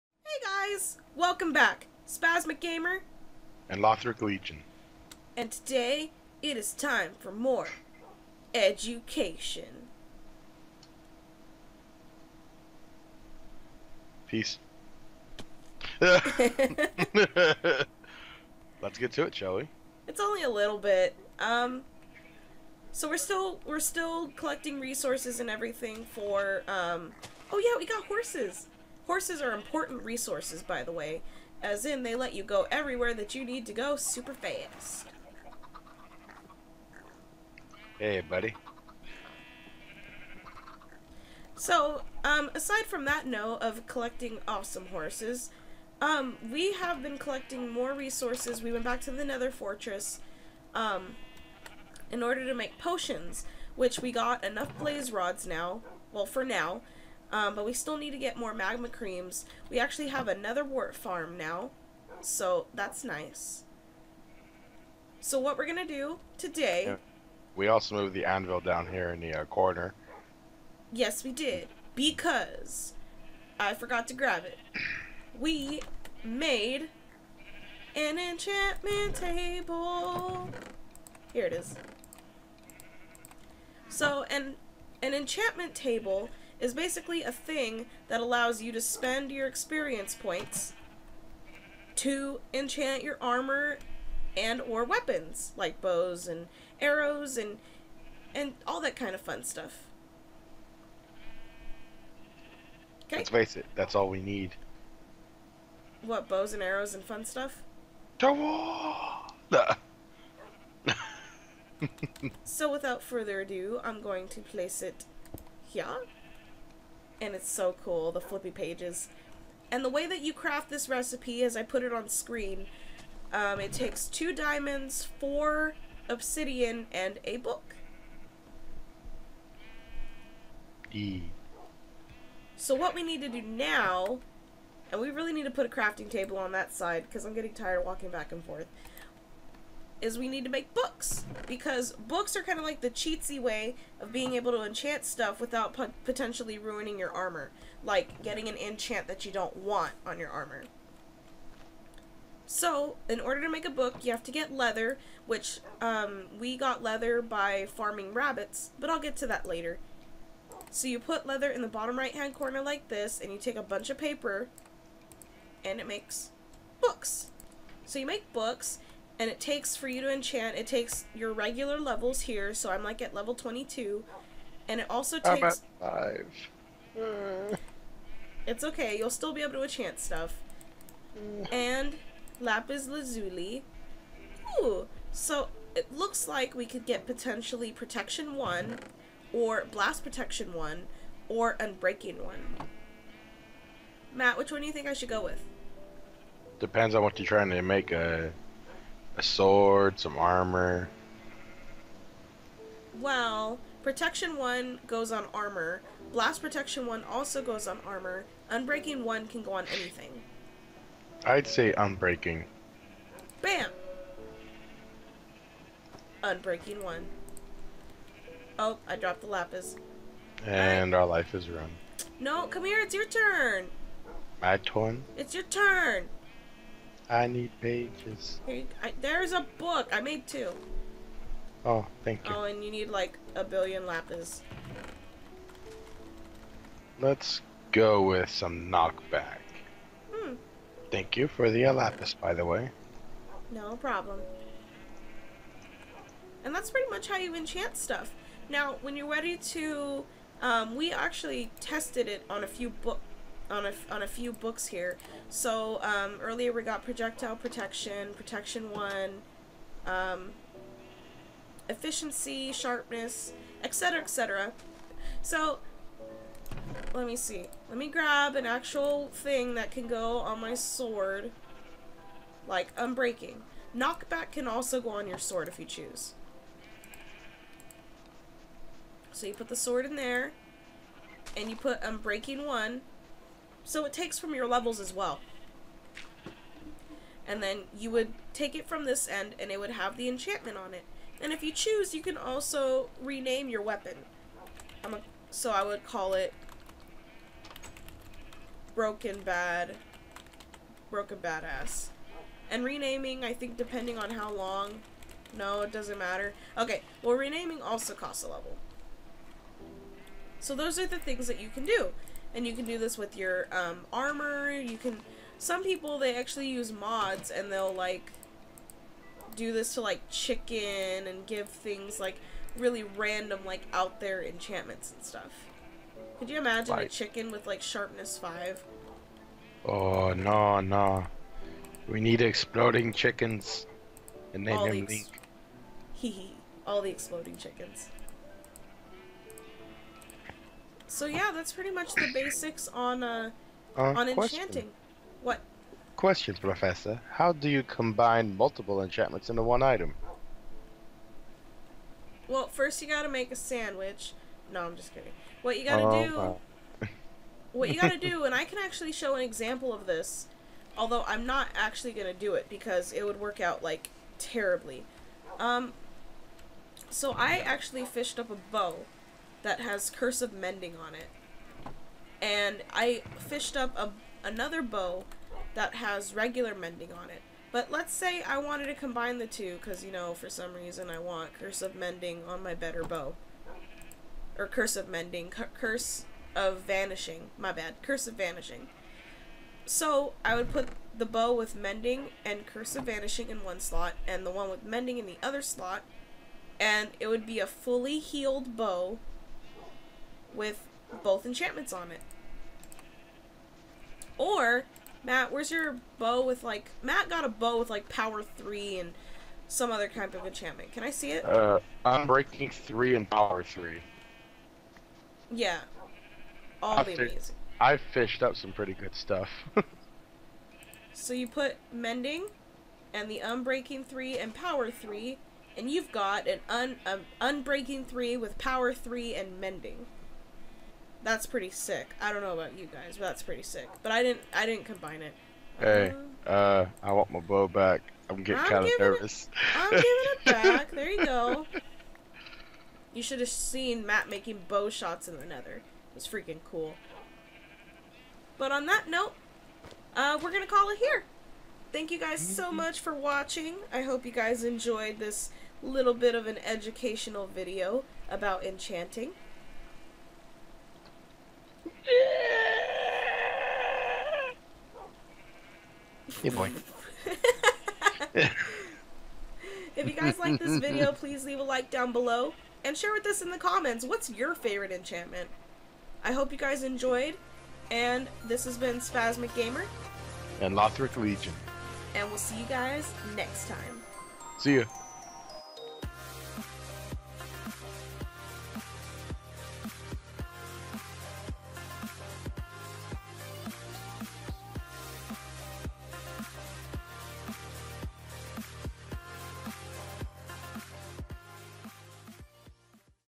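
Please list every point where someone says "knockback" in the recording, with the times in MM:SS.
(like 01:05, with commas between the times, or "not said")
03:58, 04:33.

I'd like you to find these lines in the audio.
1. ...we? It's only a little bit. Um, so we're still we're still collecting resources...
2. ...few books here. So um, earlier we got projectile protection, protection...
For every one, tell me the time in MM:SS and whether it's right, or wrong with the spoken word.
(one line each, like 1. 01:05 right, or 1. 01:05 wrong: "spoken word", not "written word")
1. 00:19 right
2. 04:14 right.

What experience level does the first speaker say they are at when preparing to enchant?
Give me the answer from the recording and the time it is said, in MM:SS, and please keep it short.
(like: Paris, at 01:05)
22, at 02:53.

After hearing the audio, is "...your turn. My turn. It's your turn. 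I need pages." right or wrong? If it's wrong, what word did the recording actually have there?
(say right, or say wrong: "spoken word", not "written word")
right.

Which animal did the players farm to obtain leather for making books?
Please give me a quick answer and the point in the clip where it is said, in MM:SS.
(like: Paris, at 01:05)
rabbits, at 02:38.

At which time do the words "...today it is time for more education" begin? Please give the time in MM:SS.
00:05.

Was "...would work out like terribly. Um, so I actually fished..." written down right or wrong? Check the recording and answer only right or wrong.
right.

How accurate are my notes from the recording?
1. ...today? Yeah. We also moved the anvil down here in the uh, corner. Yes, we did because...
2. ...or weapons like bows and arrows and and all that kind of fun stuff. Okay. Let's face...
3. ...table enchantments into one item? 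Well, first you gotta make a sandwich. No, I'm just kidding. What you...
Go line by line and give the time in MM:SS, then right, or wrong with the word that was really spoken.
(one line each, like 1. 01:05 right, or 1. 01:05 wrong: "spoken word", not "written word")
1. 01:06 right
2. 01:34 right
3. 05:48 wrong: "multiple", not "table".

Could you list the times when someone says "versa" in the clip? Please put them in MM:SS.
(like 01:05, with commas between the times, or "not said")
not said.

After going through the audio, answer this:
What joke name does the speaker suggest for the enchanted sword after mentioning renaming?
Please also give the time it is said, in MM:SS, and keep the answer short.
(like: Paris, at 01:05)
Broken Badass, at 05:00.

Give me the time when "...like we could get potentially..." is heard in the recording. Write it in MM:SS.
03:06.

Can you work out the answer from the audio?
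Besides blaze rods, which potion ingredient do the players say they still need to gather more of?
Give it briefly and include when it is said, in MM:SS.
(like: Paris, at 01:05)
magma creams, at 00:58.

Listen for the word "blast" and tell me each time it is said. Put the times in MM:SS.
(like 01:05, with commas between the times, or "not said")
03:09, 03:26.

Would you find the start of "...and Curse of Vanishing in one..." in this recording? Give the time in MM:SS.
06:32.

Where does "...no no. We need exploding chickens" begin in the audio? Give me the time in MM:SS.
05:30.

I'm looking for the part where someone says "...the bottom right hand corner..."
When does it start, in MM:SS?
02:41.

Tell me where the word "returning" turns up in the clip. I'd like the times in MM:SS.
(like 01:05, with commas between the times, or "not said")
not said.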